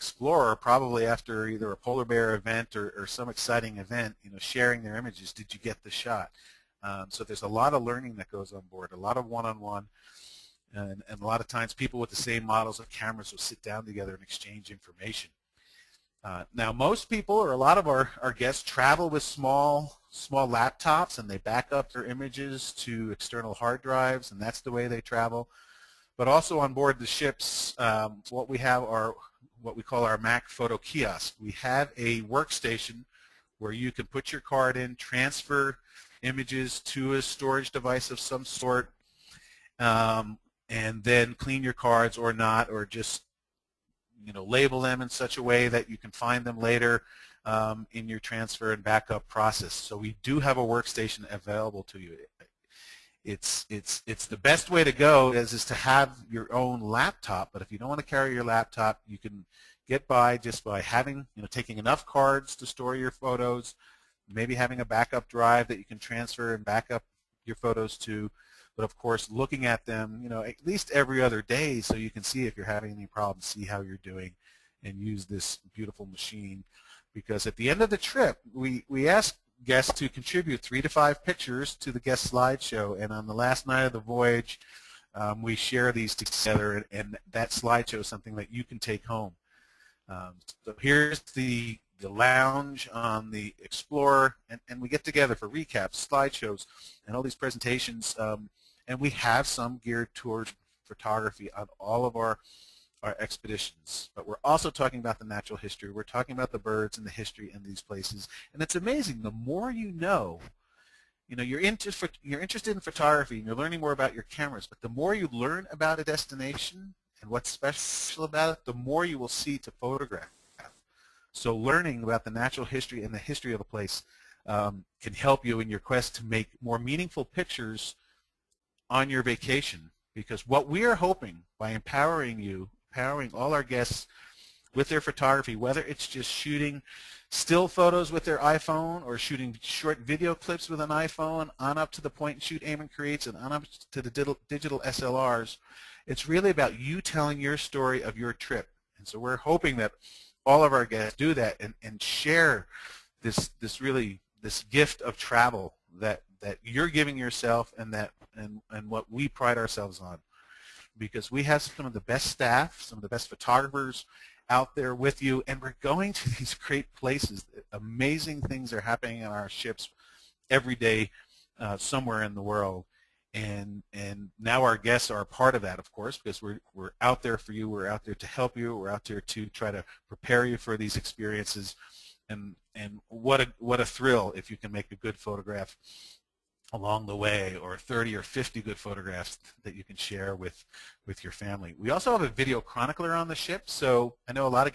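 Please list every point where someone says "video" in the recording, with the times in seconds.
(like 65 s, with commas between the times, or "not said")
139 s, 192 s.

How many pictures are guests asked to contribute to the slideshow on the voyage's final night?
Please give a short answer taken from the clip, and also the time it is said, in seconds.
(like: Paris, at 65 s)
3 to 5, at 80 s.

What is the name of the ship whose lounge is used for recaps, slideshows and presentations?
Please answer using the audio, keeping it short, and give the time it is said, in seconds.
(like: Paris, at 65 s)
Explorer, at 93 s.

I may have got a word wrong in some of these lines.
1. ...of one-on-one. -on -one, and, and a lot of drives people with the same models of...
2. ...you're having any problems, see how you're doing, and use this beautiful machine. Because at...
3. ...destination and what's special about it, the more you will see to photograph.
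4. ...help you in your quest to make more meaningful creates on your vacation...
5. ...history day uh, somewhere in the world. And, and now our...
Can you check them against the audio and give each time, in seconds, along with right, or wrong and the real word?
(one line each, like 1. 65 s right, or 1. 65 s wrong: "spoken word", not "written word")
1. 9 s wrong: "times", not "drives"
2. 72 s right
3. 116 s right
4. 125 s wrong: "pictures", not "creates"
5. 170 s wrong: "every", not "history".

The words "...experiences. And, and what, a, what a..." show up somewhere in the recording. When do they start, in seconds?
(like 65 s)
180 s.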